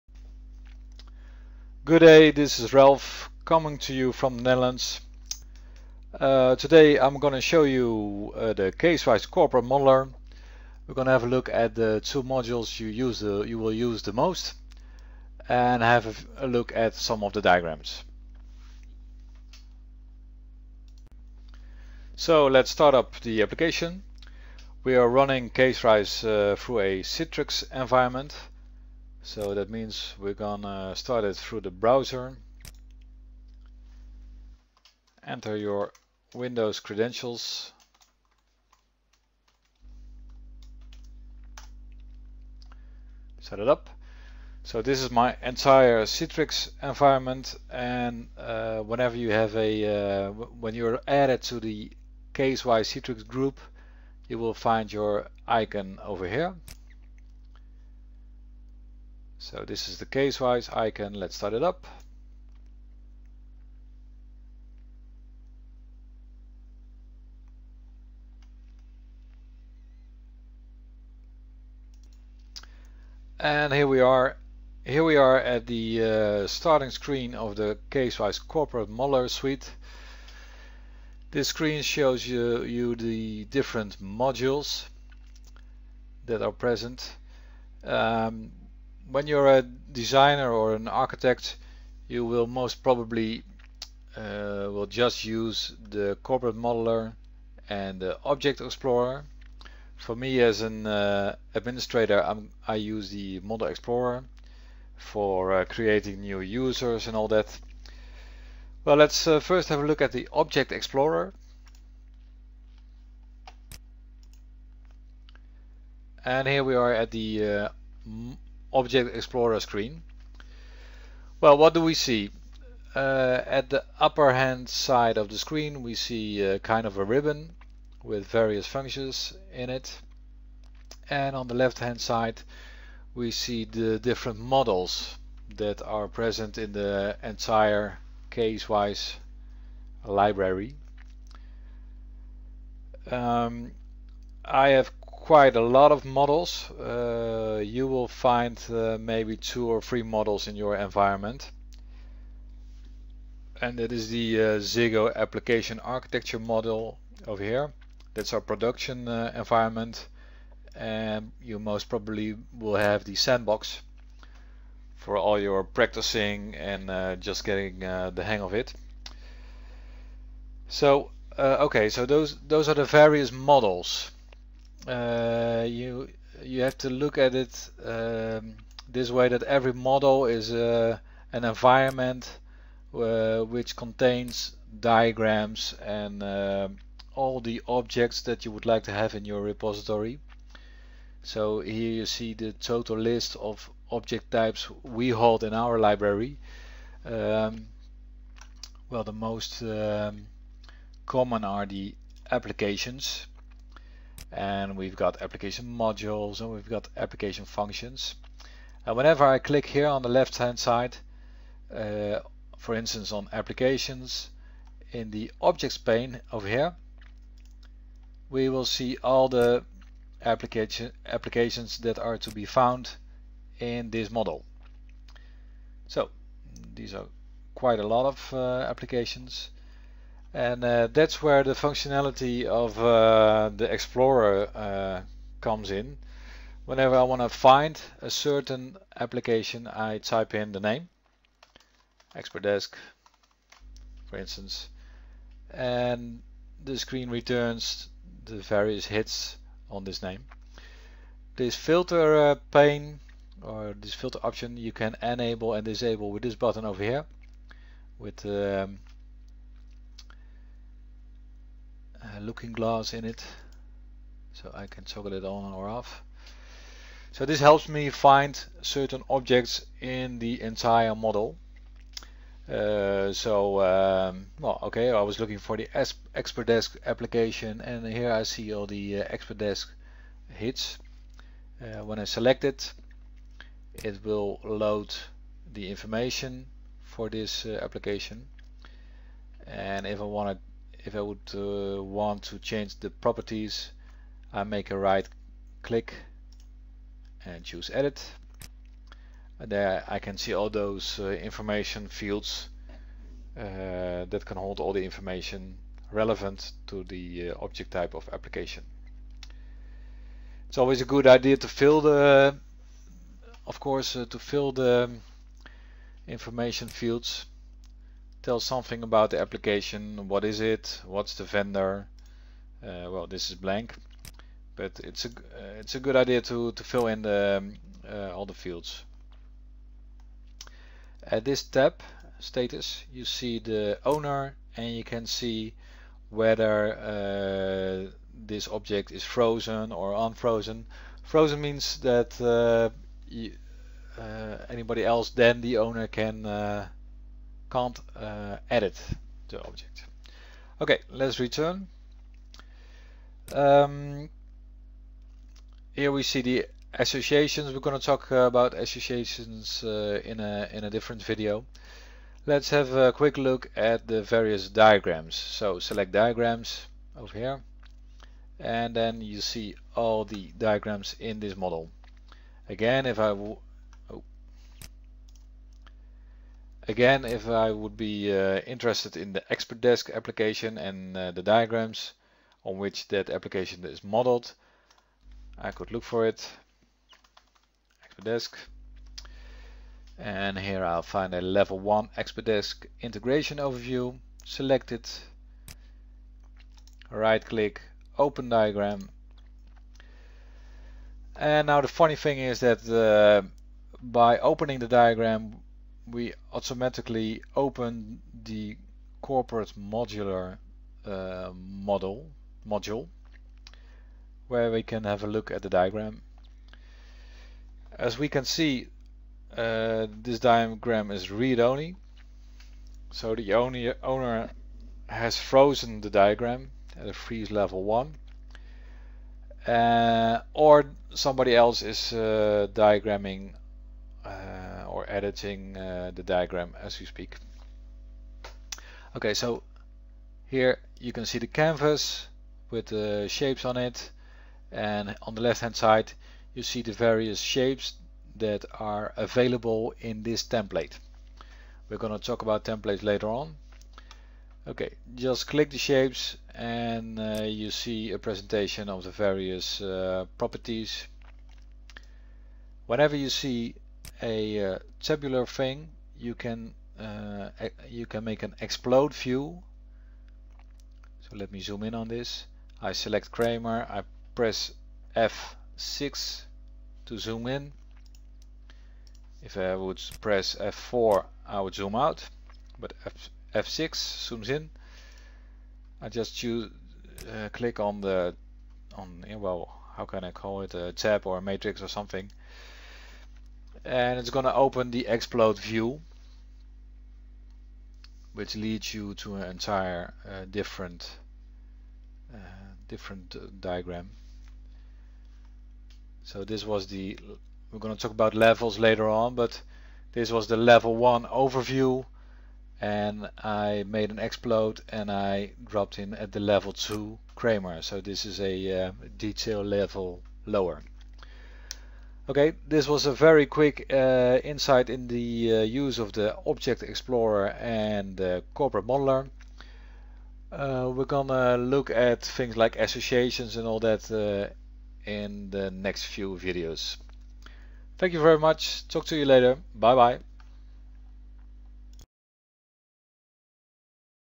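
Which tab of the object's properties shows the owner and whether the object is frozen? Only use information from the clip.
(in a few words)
status.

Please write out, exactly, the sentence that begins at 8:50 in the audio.
Uh, we're gonna look at things like associations and all that uh, in the next few videos.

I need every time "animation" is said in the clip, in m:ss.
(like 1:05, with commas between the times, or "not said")
not said.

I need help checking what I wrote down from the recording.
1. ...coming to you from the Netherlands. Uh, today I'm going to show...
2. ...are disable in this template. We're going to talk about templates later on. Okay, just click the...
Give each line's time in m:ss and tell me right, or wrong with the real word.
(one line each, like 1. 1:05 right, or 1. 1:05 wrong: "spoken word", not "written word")
1. 0:03 right
2. 7:28 wrong: "available", not "disable".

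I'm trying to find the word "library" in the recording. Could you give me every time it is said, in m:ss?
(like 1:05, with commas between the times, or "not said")
2:20, 3:15.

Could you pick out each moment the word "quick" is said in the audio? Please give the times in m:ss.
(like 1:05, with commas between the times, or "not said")
6:02, 8:43.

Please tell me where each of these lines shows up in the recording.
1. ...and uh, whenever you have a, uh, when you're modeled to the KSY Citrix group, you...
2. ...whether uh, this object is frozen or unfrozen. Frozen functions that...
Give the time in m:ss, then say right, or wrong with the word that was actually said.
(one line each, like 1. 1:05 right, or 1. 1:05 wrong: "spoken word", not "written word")
1. 0:47 wrong: "added", not "modeled"
2. 5:36 wrong: "means", not "functions".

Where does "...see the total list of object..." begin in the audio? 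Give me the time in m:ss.
3:12.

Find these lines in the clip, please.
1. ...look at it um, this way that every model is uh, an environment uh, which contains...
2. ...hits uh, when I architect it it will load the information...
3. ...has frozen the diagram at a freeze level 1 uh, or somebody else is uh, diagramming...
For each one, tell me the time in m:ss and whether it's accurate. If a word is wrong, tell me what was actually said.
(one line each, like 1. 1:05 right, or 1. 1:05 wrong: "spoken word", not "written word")
1. 2:56 right
2. 4:40 wrong: "select", not "architect"
3. 7:04 right.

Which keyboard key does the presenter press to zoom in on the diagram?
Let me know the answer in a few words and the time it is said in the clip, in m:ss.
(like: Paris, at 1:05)
F6, at 7:54.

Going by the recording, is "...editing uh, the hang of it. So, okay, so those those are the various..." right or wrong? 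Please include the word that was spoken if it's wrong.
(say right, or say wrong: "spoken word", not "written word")
wrong: "getting", not "editing".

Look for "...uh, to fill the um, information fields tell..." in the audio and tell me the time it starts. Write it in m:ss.
5:13.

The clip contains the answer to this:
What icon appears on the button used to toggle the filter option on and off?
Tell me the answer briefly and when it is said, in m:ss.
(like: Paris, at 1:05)
looking glass, at 4:22.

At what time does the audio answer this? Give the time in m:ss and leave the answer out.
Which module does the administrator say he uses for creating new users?
1:43.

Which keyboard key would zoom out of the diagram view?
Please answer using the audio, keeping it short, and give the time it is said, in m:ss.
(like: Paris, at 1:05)
F4, at 8:00.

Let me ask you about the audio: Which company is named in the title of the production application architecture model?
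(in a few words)
Ziggo.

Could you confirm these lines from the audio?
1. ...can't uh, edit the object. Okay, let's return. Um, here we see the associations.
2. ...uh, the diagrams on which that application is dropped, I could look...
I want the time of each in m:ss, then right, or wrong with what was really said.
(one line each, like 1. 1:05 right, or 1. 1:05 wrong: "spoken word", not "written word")
1. 5:47 right
2. 6:20 wrong: "modeled", not "dropped".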